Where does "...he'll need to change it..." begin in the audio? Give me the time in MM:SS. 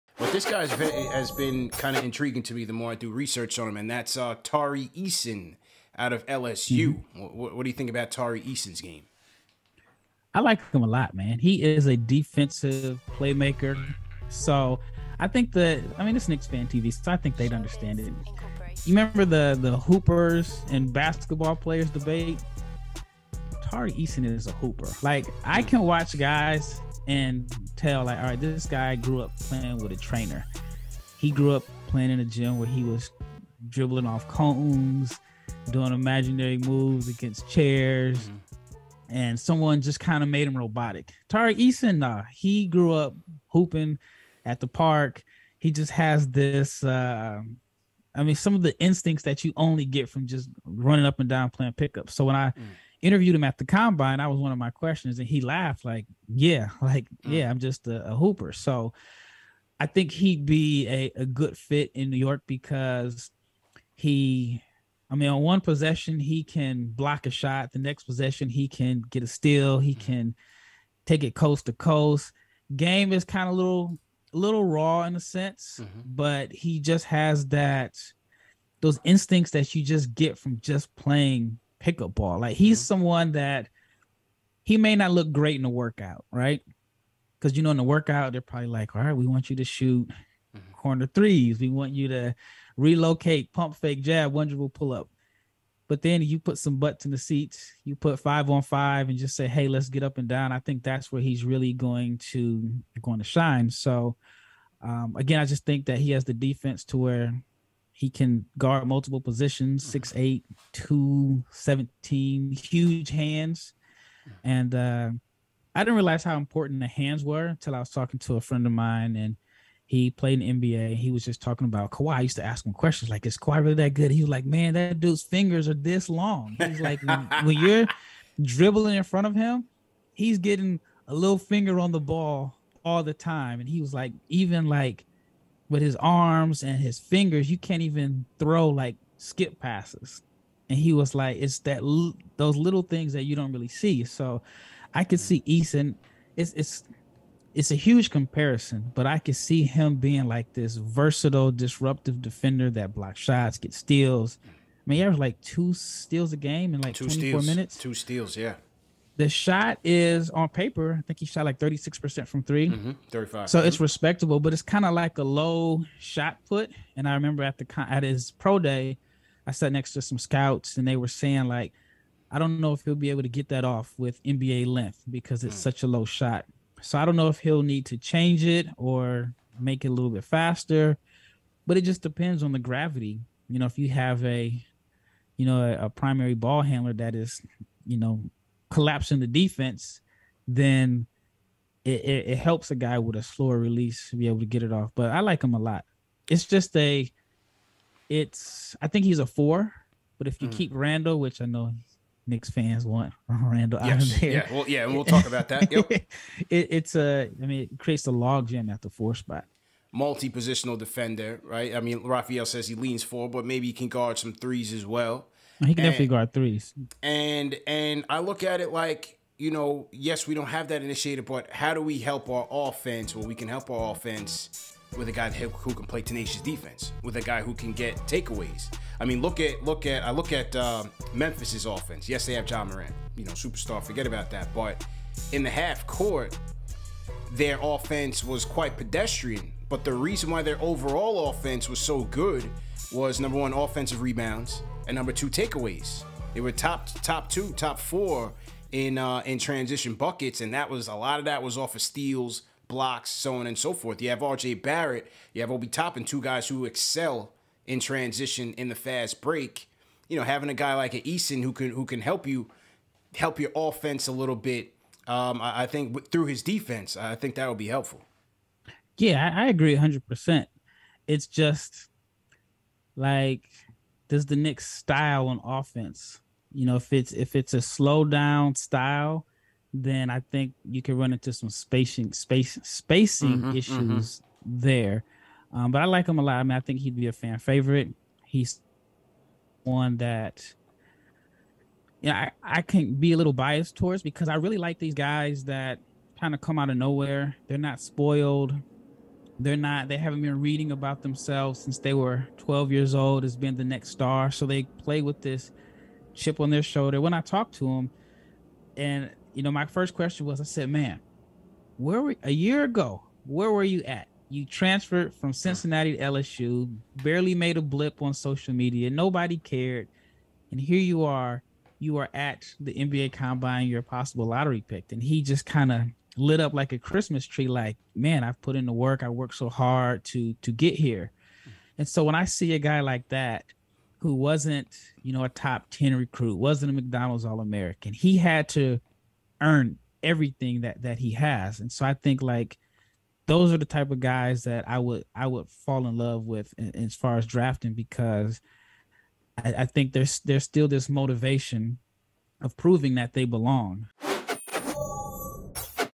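02:57.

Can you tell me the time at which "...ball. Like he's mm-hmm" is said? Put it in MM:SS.
01:22.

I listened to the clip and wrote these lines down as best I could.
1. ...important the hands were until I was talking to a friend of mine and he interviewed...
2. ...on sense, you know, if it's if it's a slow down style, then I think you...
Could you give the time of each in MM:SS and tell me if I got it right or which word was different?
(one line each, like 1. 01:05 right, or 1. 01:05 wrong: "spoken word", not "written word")
1. 01:56 wrong: "played", not "interviewed"
2. 04:35 wrong: "offense", not "sense".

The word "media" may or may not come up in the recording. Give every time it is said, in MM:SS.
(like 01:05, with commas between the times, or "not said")
05:18.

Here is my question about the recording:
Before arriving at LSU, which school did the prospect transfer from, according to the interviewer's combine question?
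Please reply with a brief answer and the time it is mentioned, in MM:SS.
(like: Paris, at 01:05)
Cincinnati, at 05:15.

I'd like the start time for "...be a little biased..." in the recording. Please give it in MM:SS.
04:52.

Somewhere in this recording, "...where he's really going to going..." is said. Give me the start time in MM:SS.
01:41.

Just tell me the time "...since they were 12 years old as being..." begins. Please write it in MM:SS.
05:01.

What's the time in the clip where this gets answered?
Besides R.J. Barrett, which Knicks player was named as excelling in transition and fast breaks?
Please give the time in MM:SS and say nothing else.
04:15.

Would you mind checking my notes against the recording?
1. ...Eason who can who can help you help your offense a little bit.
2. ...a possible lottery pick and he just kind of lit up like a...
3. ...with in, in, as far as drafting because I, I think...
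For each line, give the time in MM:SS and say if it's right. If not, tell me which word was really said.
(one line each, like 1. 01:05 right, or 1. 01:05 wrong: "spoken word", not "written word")
1. 04:21 right
2. 05:23 right
3. 05:46 right.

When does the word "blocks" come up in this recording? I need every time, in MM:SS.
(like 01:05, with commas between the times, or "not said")
01:06, 02:32, 04:12.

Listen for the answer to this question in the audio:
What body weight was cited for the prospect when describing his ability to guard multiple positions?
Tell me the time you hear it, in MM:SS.
01:50.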